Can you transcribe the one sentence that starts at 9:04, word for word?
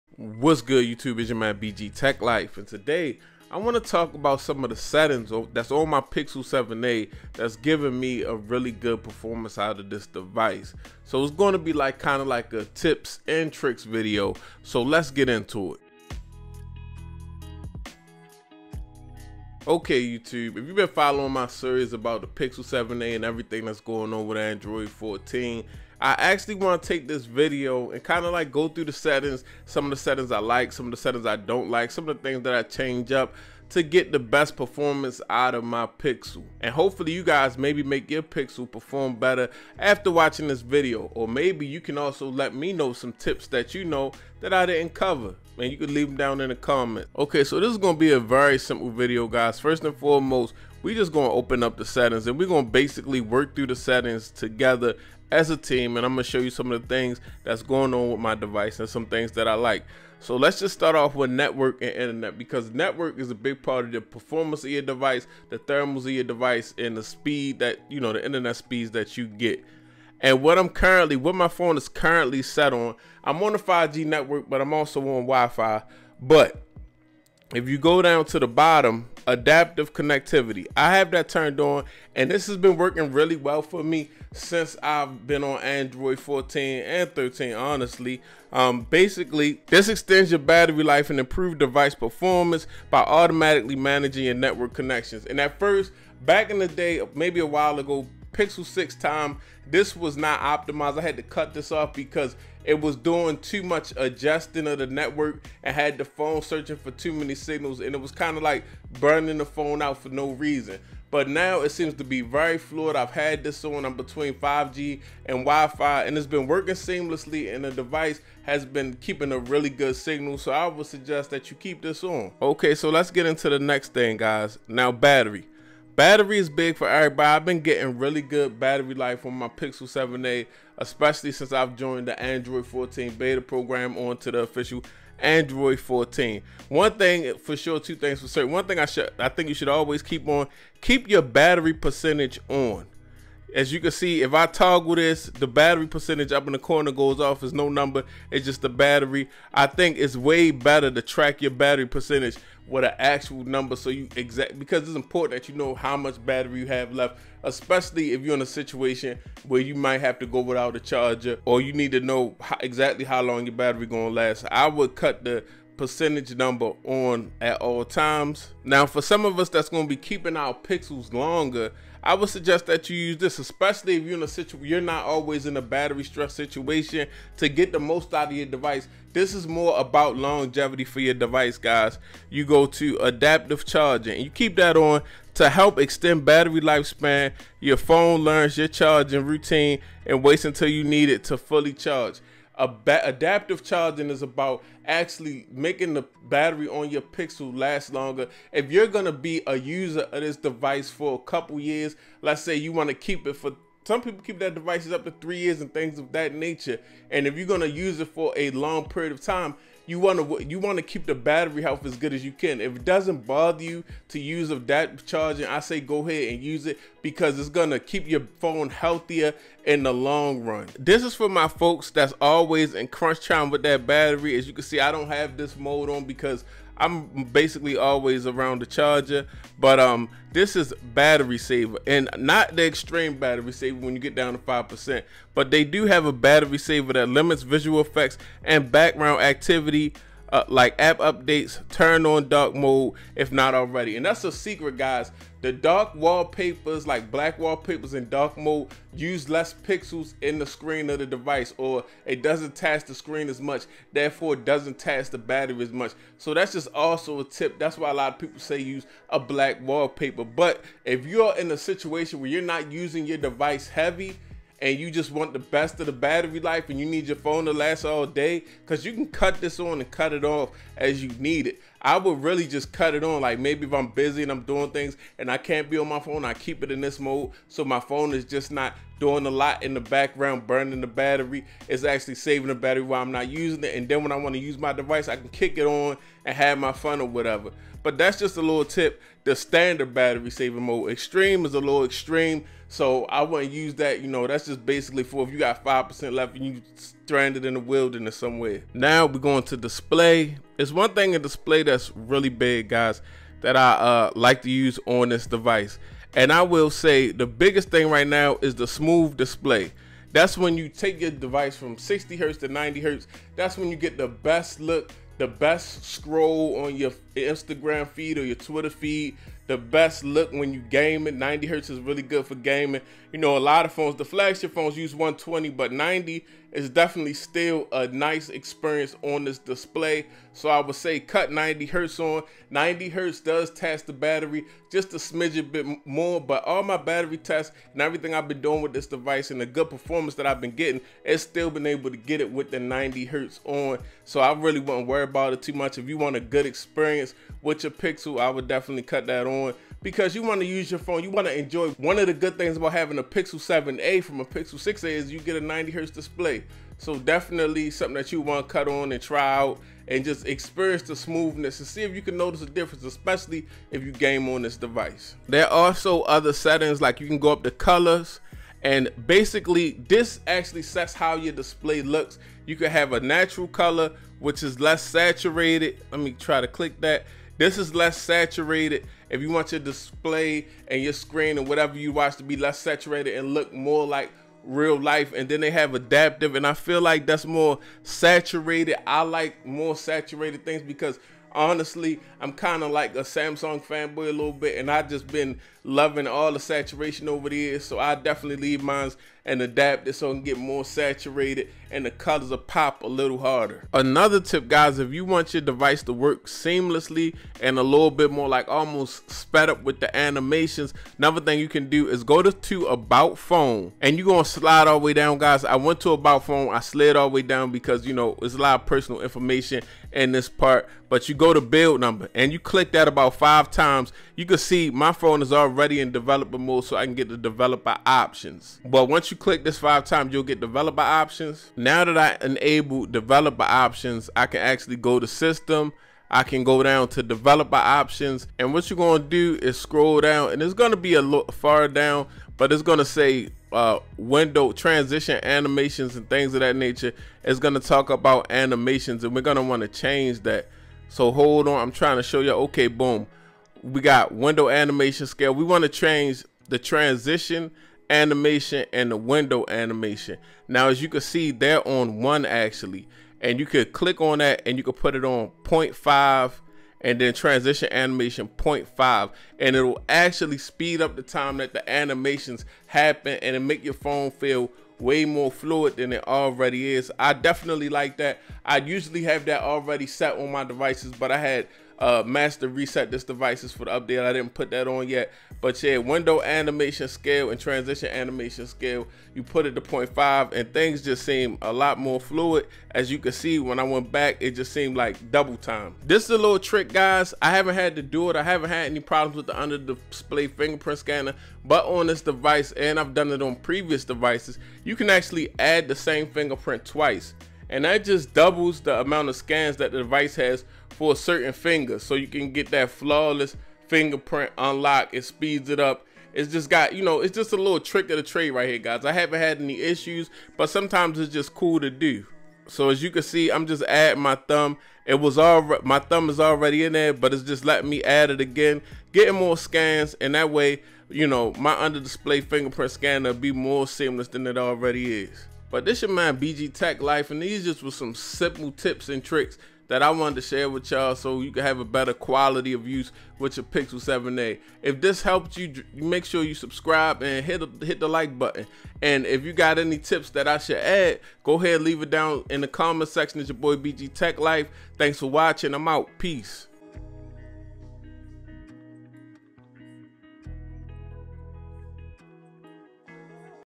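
If this helped you, make sure you subscribe and hit, hit the like button.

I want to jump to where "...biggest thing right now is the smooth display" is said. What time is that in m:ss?
5:07.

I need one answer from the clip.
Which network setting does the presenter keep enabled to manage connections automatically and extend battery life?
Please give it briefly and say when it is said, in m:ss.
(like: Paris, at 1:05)
Adaptive connectivity, at 1:19.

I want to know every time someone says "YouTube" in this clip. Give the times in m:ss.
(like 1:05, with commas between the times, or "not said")
0:00, 0:20.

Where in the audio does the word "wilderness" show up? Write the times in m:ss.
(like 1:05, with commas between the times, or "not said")
4:57.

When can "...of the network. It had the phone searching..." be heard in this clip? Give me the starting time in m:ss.
1:44.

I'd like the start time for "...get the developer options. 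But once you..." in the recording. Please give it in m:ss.
7:06.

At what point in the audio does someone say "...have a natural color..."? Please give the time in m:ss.
6:12.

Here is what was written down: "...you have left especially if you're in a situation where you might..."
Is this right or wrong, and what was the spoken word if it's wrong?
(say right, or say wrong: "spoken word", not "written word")
right.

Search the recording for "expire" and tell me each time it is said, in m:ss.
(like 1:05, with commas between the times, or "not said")
not said.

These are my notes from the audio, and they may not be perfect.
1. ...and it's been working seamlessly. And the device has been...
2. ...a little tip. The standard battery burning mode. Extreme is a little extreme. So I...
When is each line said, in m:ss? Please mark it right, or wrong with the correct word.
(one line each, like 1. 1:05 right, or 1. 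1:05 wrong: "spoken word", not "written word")
1. 1:56 right
2. 4:48 wrong: "saving", not "burning".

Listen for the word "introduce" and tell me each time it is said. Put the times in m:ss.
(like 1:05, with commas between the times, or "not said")
not said.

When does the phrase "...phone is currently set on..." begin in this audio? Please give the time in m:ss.
1:11.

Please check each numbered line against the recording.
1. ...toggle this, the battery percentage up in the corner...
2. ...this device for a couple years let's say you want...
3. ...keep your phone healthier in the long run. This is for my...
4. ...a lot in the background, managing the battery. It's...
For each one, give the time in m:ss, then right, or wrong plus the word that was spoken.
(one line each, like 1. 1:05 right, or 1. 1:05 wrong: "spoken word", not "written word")
1. 2:24 right
2. 3:20 right
3. 3:37 right
4. 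4:39 wrong: "burning", not "managing".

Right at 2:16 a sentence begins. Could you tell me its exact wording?
One thing for sure, two things for certain.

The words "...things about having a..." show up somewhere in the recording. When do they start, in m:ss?
5:52.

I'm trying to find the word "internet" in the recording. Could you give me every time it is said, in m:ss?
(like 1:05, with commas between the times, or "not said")
1:01, 1:08.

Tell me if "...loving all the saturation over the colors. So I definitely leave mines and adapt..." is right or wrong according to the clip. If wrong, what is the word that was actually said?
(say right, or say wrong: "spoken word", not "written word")
wrong: "years", not "colors".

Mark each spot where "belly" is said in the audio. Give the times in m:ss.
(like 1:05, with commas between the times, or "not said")
not said.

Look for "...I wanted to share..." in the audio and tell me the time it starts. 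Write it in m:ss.
8:59.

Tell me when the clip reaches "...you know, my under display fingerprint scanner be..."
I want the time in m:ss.
8:50.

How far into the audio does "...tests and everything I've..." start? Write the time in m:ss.
5:37.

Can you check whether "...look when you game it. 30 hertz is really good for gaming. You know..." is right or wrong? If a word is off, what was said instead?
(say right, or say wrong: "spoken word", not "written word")
wrong: "90", not "30".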